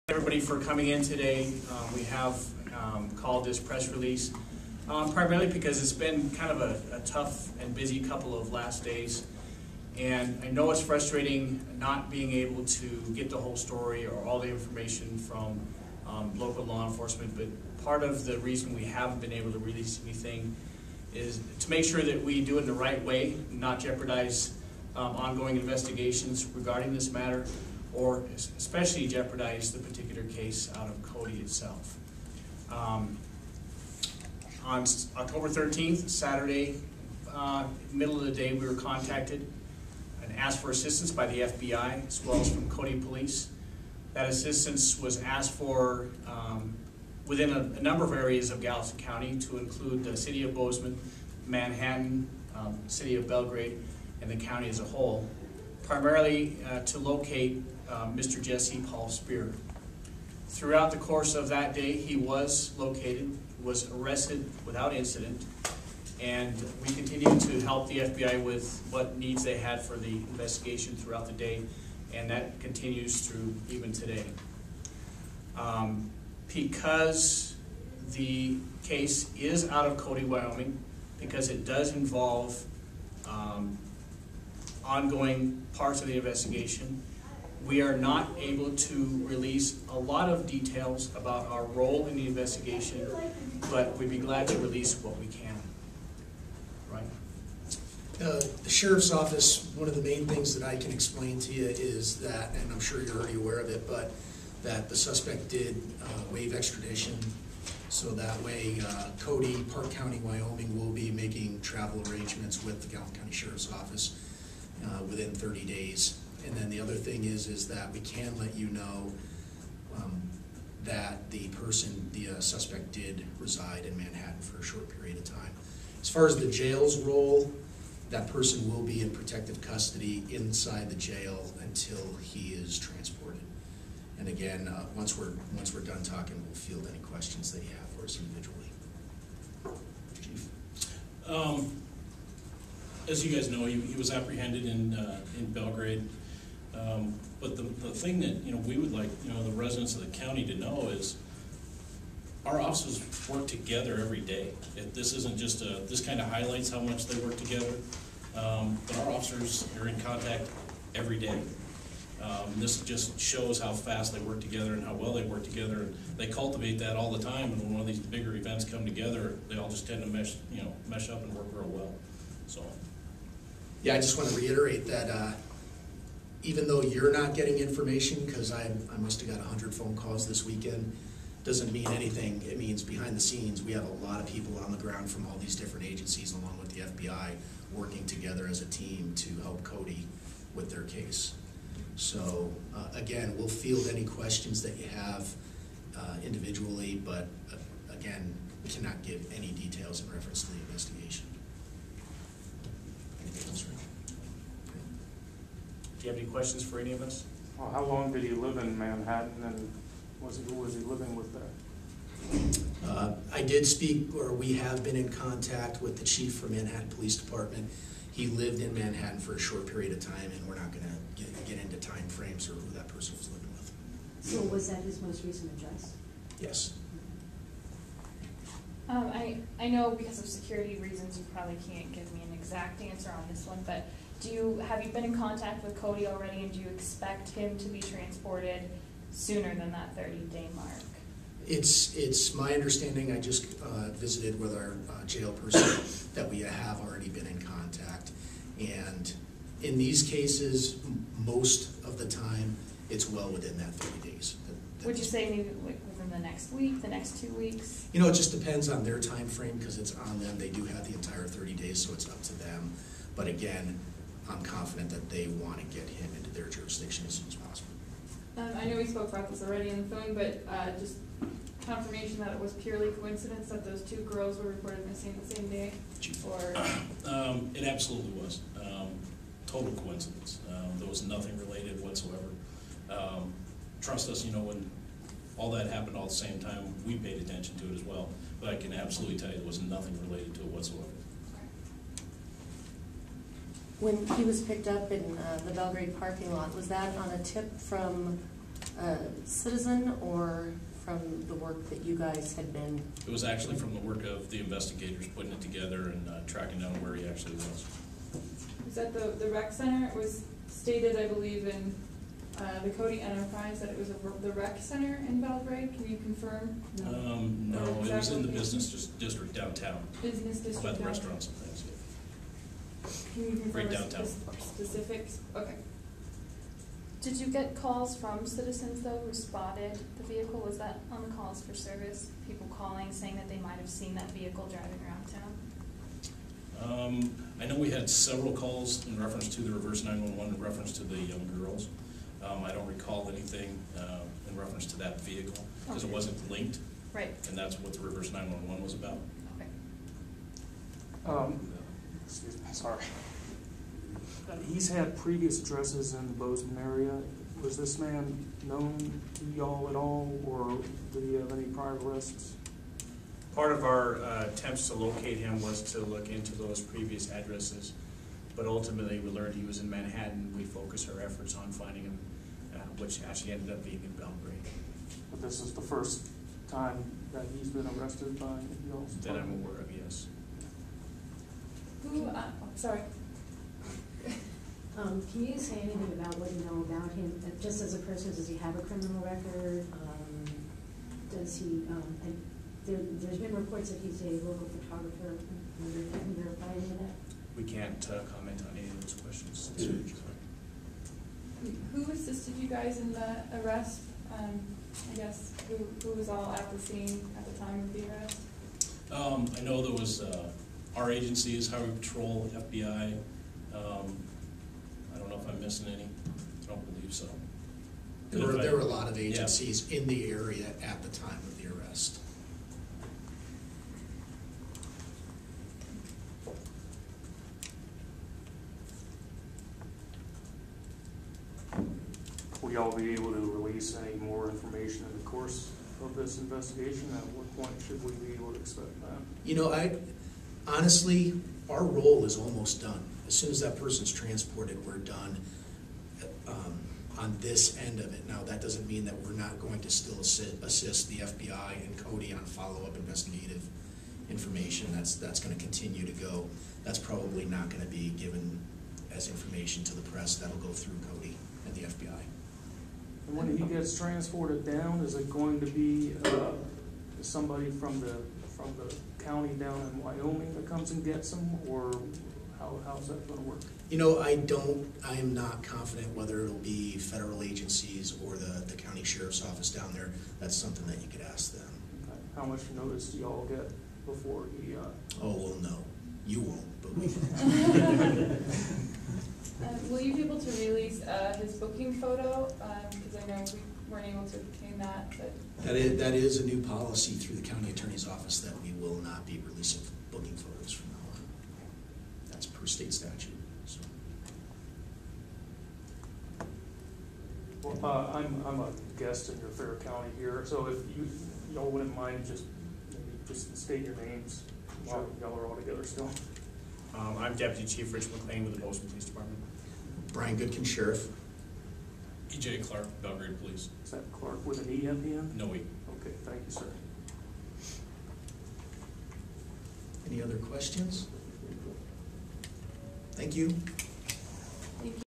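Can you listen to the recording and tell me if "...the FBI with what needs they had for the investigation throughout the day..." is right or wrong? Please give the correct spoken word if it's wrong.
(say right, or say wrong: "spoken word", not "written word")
right.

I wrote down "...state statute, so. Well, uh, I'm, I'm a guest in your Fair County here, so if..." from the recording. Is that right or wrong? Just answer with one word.
right.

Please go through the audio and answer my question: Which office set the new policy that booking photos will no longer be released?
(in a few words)
county attorney's office.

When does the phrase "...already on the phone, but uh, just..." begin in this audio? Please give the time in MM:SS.
04:29.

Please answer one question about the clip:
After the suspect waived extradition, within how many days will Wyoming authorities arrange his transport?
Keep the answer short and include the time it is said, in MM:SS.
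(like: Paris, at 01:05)
30 days, at 01:55.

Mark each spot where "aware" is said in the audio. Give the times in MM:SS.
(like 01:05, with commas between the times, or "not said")
01:43, 06:19.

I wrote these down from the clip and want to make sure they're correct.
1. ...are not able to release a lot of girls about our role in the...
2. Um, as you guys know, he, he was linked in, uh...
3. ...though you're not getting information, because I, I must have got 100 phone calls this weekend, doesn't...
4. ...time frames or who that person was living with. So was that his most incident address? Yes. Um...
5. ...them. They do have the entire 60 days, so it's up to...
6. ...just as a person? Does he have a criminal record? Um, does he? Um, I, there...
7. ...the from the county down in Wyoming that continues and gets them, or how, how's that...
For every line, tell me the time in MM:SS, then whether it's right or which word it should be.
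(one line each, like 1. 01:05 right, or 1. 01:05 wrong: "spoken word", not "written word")
1. 01:27 wrong: "details", not "girls"
2. 02:21 wrong: "apprehended", not "linked"
3. 02:56 right
4. 03:41 wrong: "recent", not "incident"
5. 04:20 wrong: "30", not "60"
6. 06:27 right
7. 07:47 wrong: "comes", not "continues".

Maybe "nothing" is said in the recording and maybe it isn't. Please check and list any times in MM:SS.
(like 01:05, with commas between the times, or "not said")
04:41, 04:49.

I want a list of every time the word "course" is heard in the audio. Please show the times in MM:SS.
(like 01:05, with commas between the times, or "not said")
01:00, 07:15.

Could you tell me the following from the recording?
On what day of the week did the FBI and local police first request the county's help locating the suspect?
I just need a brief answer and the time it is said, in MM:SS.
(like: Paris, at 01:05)
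Saturday, at 00:36.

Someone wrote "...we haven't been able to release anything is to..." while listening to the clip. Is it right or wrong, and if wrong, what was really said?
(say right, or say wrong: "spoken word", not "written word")
right.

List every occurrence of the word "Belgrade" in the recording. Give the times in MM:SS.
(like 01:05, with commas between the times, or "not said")
00:53, 02:25, 04:55, 05:15, 06:13, 08:42.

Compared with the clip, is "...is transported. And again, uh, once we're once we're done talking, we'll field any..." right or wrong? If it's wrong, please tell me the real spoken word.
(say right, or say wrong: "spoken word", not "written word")
right.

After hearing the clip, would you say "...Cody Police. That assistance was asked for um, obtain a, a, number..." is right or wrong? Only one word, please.
wrong.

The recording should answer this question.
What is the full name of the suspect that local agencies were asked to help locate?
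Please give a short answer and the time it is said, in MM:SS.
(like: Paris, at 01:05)
Jesse Paul Spear, at 00:58.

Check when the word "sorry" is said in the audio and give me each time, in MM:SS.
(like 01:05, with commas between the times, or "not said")
05:52, 06:22.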